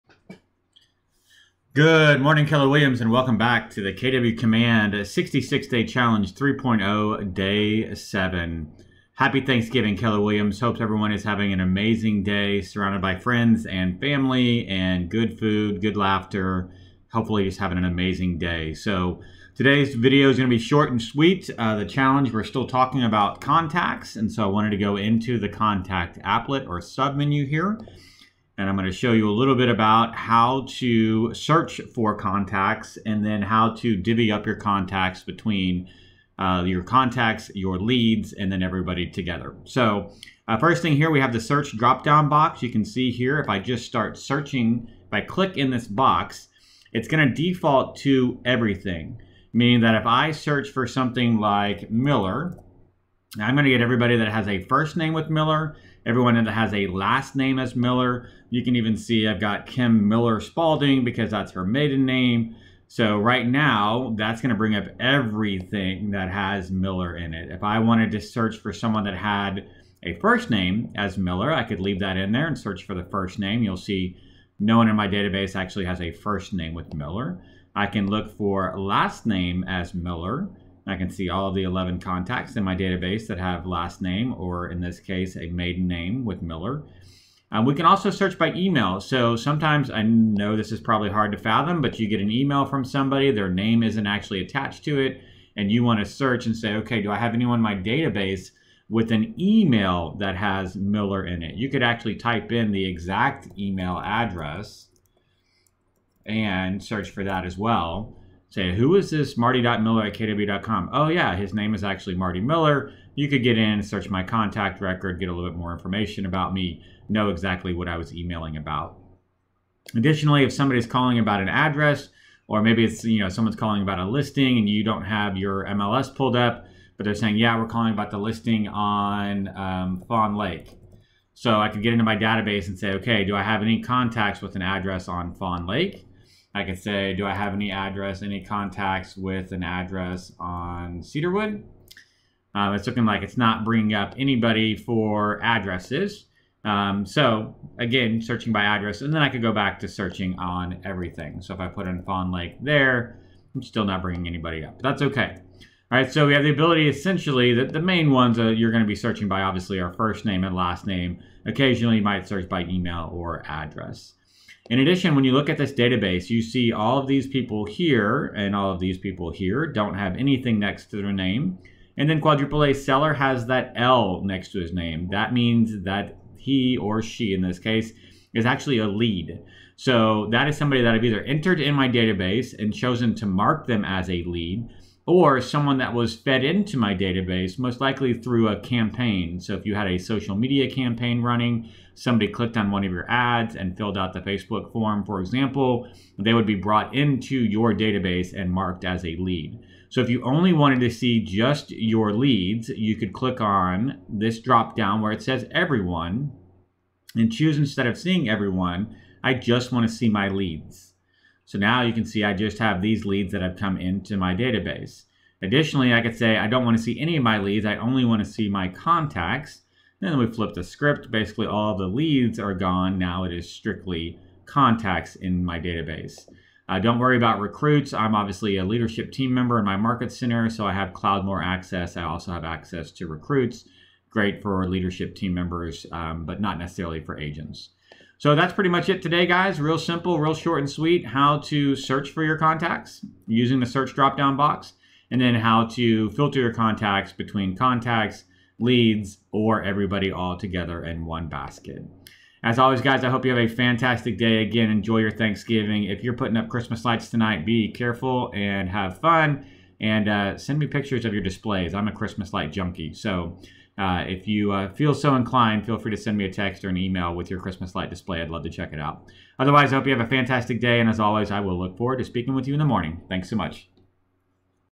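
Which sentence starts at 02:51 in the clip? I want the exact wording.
And then quadruple A seller has that L next to his name.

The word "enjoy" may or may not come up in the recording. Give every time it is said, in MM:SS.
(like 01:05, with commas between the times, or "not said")
04:14.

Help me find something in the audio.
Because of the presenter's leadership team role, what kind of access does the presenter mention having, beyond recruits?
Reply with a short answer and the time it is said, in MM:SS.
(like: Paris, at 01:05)
Cloudmore access, at 03:50.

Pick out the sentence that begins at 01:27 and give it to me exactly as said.
Um, we can also search by email.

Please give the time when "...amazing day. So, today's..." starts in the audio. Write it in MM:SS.
00:17.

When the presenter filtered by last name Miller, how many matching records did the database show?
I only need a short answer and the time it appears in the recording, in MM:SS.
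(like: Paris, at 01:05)
11, at 01:21.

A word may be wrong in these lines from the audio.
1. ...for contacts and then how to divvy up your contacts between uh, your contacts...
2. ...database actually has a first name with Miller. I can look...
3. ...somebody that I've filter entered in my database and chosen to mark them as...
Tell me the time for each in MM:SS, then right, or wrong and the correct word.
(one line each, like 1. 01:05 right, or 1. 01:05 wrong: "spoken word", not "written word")
1. 00:31 right
2. 01:15 right
3. 03:00 wrong: "either", not "filter".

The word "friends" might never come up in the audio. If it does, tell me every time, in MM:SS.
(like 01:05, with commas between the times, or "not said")
00:13.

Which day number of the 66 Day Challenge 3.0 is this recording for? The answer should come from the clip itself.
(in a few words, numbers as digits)
Day 7.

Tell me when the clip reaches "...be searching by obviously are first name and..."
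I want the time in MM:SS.
02:38.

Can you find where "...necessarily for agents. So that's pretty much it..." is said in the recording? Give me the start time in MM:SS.
03:56.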